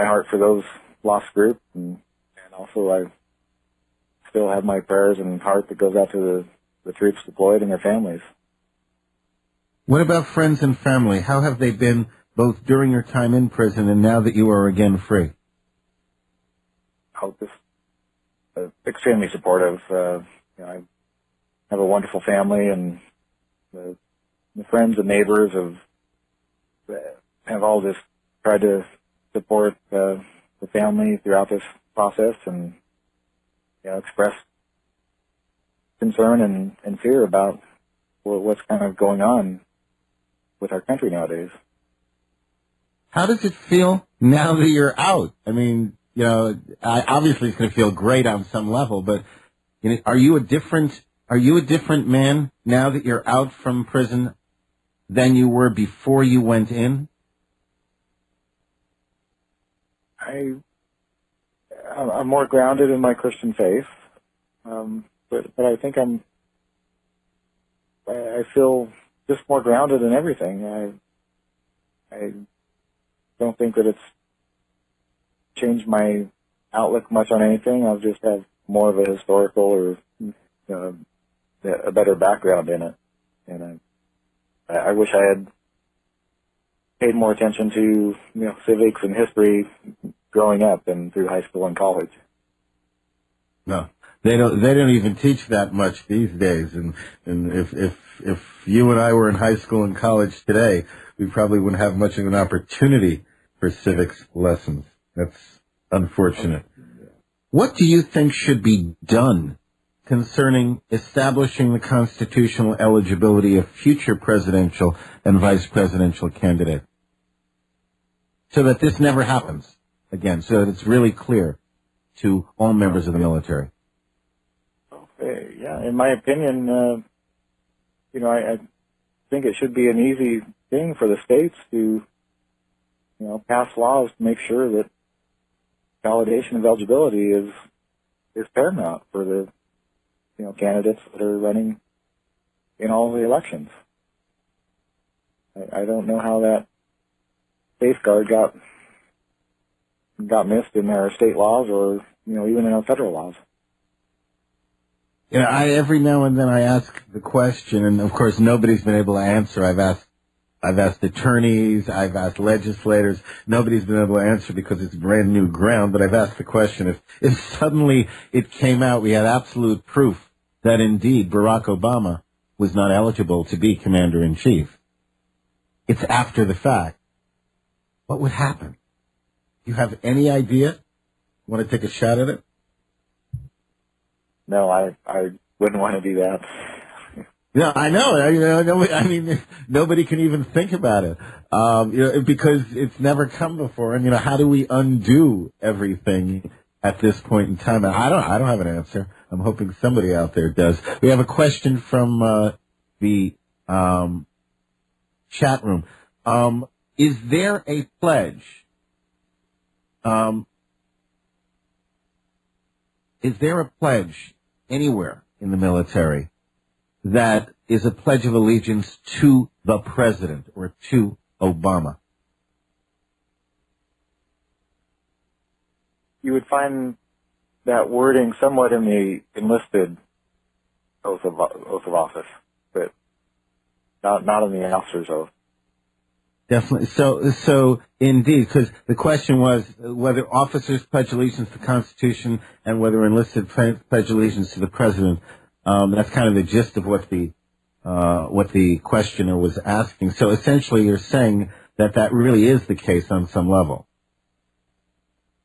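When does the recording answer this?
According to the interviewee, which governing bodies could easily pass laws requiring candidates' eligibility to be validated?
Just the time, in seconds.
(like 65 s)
131 s.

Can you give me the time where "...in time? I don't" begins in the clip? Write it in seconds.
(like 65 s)
197 s.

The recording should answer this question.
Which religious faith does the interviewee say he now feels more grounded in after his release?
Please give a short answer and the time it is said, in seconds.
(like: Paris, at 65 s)
Christian faith, at 63 s.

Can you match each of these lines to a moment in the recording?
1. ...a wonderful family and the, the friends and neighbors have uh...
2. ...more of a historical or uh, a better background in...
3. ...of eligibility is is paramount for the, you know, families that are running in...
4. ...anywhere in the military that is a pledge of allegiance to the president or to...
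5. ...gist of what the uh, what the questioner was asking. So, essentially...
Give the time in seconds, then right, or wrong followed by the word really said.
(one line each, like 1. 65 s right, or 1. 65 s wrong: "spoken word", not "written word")
1. 21 s right
2. 78 s right
3. 136 s wrong: "candidates", not "families"
4. 214 s right
5. 246 s right.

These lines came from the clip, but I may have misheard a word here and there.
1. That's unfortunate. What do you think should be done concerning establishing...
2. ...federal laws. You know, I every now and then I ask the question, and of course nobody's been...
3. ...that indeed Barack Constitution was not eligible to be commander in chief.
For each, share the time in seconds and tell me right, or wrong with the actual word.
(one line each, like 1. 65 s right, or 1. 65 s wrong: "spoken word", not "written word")
1. 105 s right
2. 152 s right
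3. 170 s wrong: "Obama", not "Constitution".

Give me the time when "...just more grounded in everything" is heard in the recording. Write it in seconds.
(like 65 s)
69 s.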